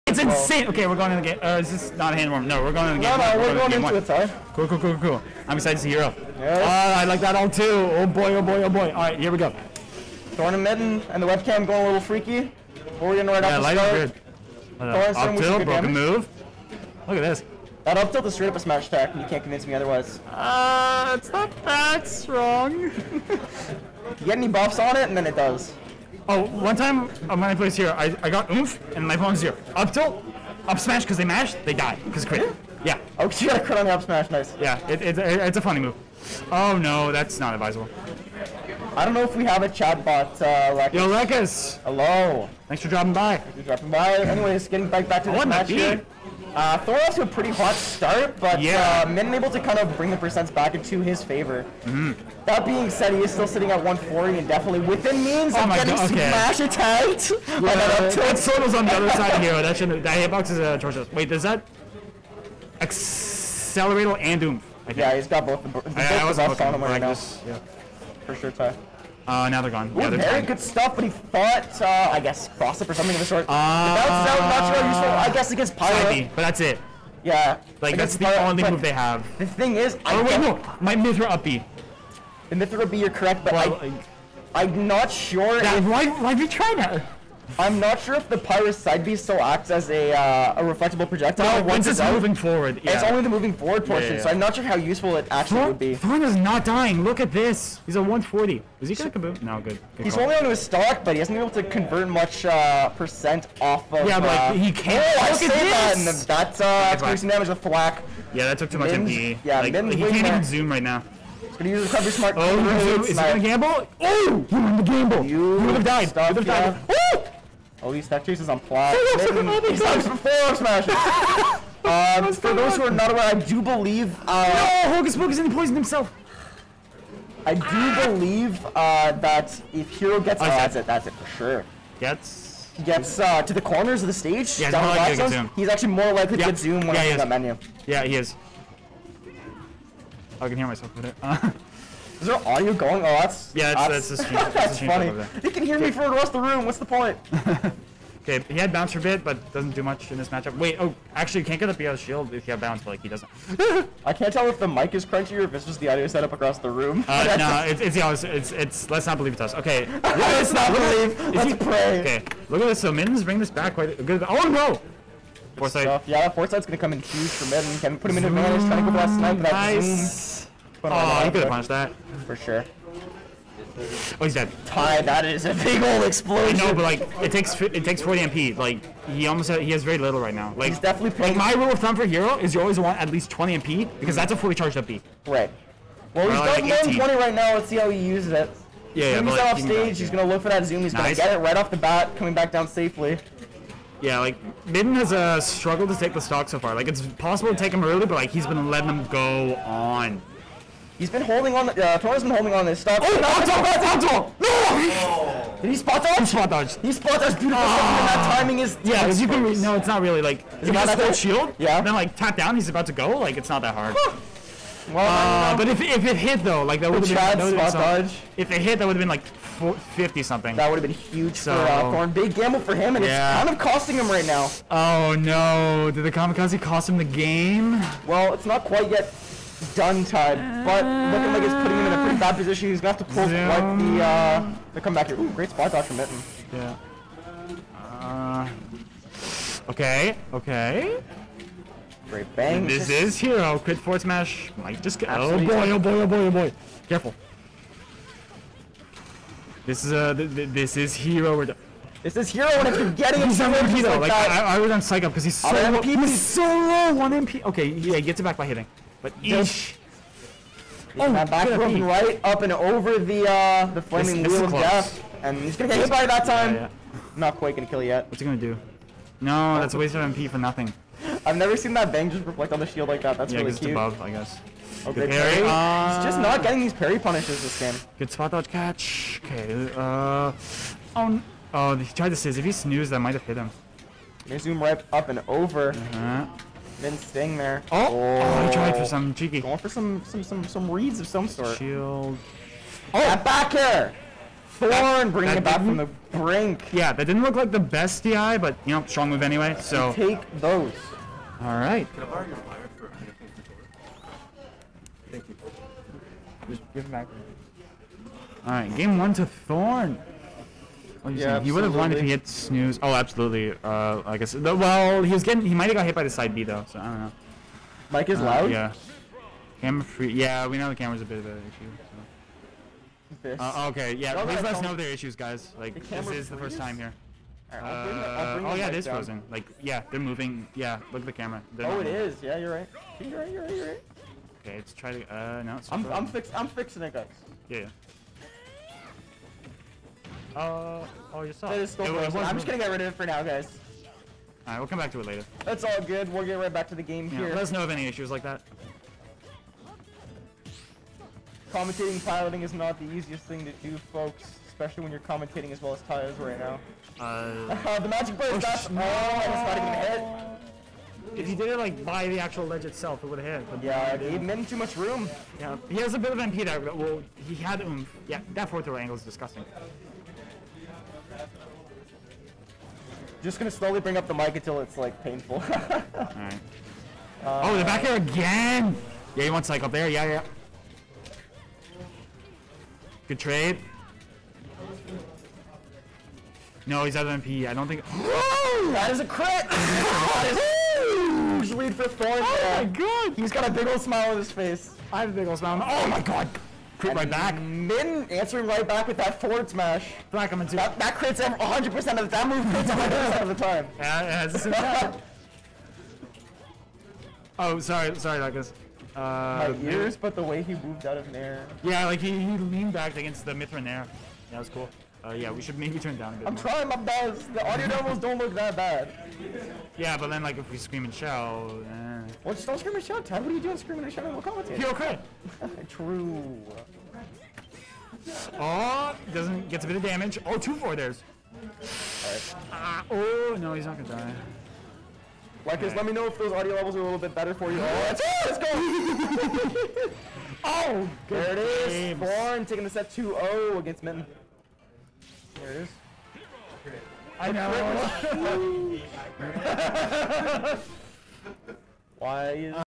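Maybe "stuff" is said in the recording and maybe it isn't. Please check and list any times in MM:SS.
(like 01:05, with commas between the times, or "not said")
01:10, 02:45, 03:22.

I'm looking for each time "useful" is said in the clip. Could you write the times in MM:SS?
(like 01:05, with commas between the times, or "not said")
01:14, 01:34.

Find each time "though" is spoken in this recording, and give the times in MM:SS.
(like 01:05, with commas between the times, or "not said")
03:36, 04:13, 05:16.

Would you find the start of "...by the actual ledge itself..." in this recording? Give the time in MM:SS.
06:01.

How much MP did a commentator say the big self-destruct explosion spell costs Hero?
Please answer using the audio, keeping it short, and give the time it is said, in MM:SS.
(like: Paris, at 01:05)
40 MP, at 02:58.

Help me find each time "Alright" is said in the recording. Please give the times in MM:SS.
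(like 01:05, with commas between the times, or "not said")
05:44, 06:15.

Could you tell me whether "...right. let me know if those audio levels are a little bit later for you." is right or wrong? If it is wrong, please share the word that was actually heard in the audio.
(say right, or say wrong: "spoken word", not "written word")
wrong: "better", not "later".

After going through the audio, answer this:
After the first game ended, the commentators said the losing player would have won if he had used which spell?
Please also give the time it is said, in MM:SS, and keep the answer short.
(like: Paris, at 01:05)
Snooze, at 05:12.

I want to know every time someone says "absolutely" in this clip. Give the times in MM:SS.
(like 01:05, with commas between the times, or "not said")
04:05, 05:12.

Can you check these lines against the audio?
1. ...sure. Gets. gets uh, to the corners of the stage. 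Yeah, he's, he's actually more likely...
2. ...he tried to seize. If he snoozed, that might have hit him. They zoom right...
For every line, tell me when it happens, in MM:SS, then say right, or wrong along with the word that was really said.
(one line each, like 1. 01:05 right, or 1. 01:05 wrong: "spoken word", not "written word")
1. 02:11 right
2. 04:41 right.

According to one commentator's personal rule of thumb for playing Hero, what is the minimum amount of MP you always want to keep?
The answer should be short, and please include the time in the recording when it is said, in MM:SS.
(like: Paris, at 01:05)
20 MP, at 03:03.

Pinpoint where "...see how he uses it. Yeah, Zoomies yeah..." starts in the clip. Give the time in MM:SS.
03:07.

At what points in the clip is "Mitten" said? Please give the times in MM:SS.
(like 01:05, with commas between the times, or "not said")
00:10, 03:14, 03:55, 07:23.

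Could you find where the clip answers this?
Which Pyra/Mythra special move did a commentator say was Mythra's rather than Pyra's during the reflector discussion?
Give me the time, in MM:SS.
01:20.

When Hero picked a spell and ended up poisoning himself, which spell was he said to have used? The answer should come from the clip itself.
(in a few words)
Hocus Pocus.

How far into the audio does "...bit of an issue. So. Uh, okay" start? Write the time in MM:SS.
05:21.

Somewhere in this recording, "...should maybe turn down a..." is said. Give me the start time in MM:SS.
06:55.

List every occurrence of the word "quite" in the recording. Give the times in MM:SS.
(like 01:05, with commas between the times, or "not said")
02:43, 03:48, 04:27.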